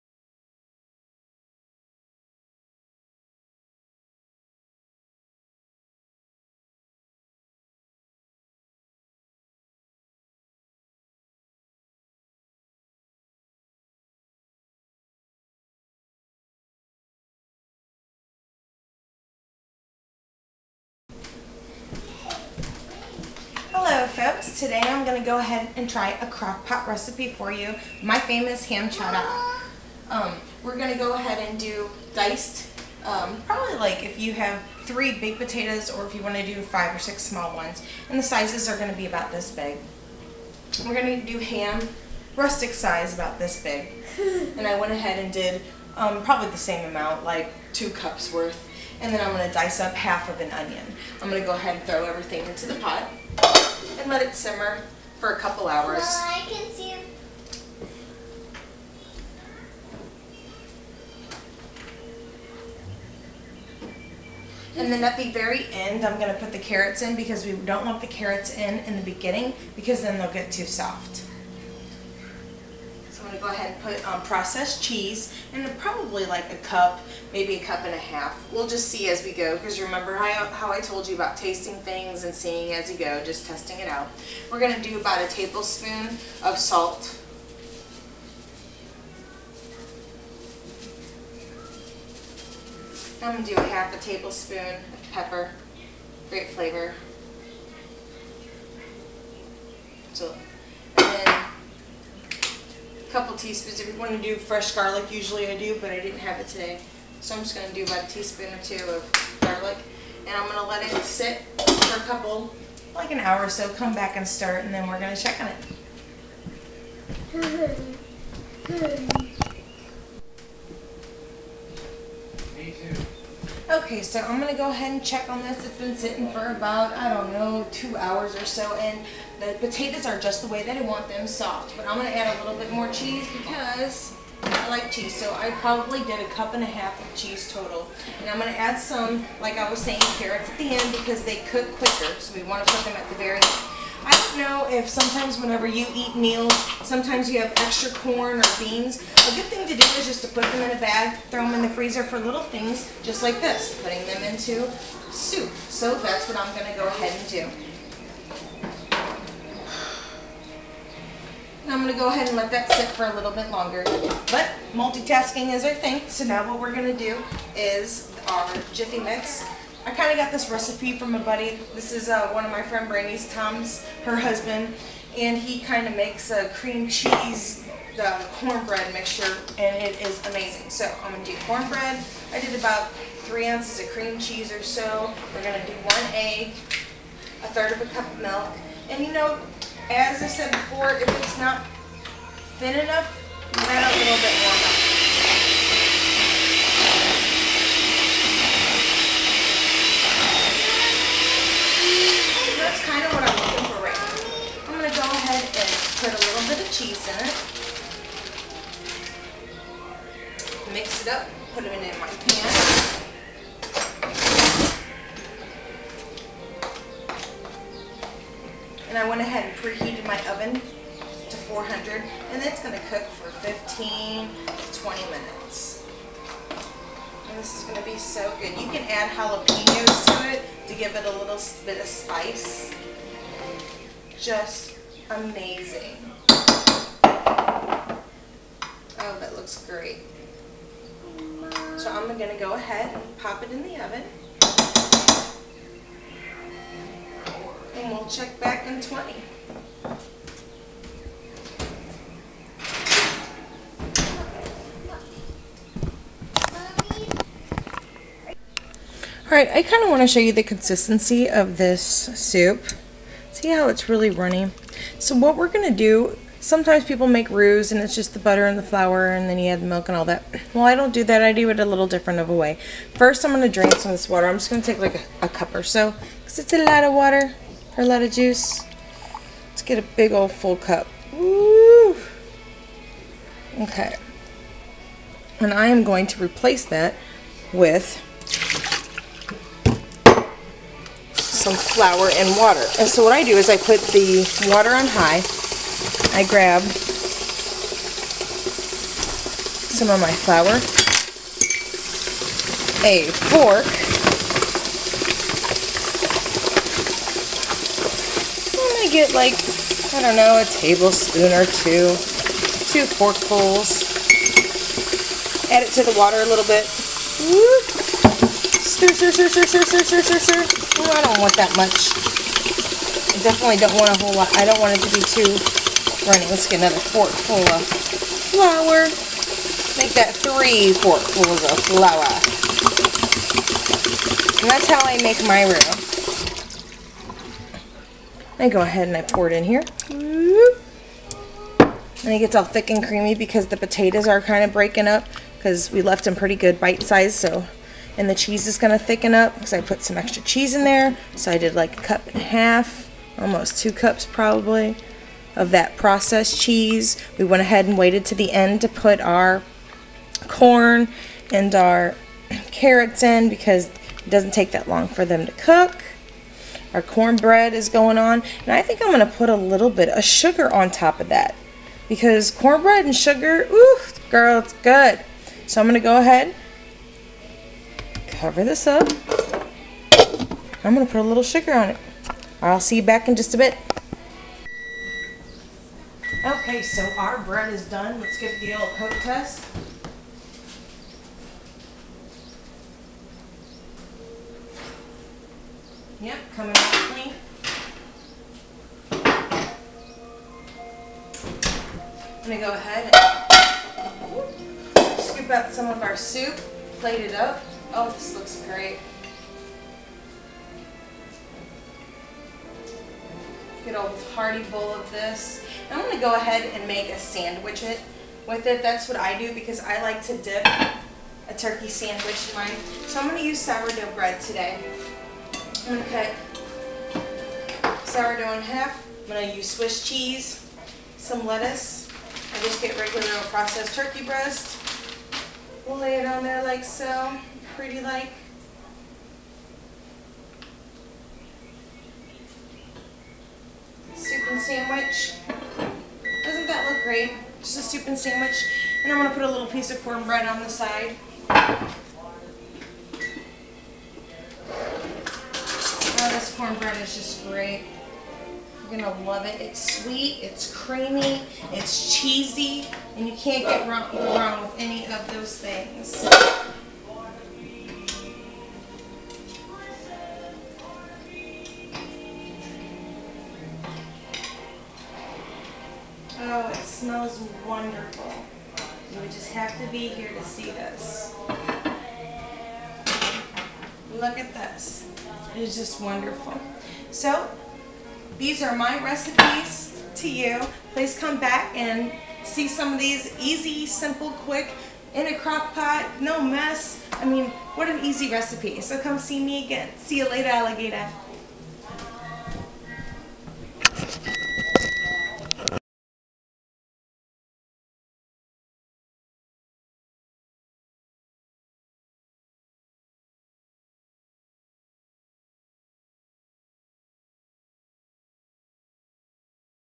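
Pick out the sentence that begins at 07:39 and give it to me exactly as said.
It's sweet, it's creamy, it's cheesy, and you can't get wrong, wrong with any of those things.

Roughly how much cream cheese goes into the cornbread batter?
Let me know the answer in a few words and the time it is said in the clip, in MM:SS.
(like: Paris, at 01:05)
3 ounces, at 03:03.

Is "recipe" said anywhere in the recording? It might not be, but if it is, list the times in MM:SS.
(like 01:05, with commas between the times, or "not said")
00:26, 02:50, 08:08, 08:18.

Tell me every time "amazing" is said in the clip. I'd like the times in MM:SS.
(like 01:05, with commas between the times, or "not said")
03:00, 03:55.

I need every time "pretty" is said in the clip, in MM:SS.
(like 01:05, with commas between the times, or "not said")
05:46, 07:17.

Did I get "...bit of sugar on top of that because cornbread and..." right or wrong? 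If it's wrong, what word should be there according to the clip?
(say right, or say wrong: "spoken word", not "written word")
right.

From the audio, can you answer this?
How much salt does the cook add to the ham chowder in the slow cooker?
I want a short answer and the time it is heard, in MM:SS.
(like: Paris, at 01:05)
1 tablespoon, at 01:24.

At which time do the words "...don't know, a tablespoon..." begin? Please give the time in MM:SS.
05:10.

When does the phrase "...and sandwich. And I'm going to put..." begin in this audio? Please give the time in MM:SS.
07:27.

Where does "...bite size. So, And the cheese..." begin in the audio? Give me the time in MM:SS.
05:46.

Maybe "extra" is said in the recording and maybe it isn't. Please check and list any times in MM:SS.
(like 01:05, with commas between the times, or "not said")
02:27, 05:49.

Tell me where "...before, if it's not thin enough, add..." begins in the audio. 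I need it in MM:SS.
03:10.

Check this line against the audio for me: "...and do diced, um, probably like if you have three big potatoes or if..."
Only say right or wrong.
right.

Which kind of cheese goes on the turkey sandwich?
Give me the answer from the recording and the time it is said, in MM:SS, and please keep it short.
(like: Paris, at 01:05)
Swiss, at 07:09.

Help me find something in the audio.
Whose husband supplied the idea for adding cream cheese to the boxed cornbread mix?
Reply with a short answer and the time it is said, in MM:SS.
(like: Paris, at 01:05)
Brandy, at 02:52.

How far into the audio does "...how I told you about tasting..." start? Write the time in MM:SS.
01:20.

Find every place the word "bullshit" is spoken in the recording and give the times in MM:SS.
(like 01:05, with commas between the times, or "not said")
not said.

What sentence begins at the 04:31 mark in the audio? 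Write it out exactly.
I do it a little different of a way.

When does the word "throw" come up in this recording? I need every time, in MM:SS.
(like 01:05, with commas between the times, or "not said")
00:51, 02:31.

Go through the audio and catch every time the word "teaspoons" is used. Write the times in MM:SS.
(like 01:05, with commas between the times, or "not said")
01:43, 01:48.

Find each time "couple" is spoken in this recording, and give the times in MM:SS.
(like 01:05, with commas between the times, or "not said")
00:55, 01:43, 01:52.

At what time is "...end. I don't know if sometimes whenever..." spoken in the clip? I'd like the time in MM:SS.
02:23.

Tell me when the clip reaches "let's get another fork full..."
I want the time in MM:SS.
05:26.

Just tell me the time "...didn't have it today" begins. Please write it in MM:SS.
01:45.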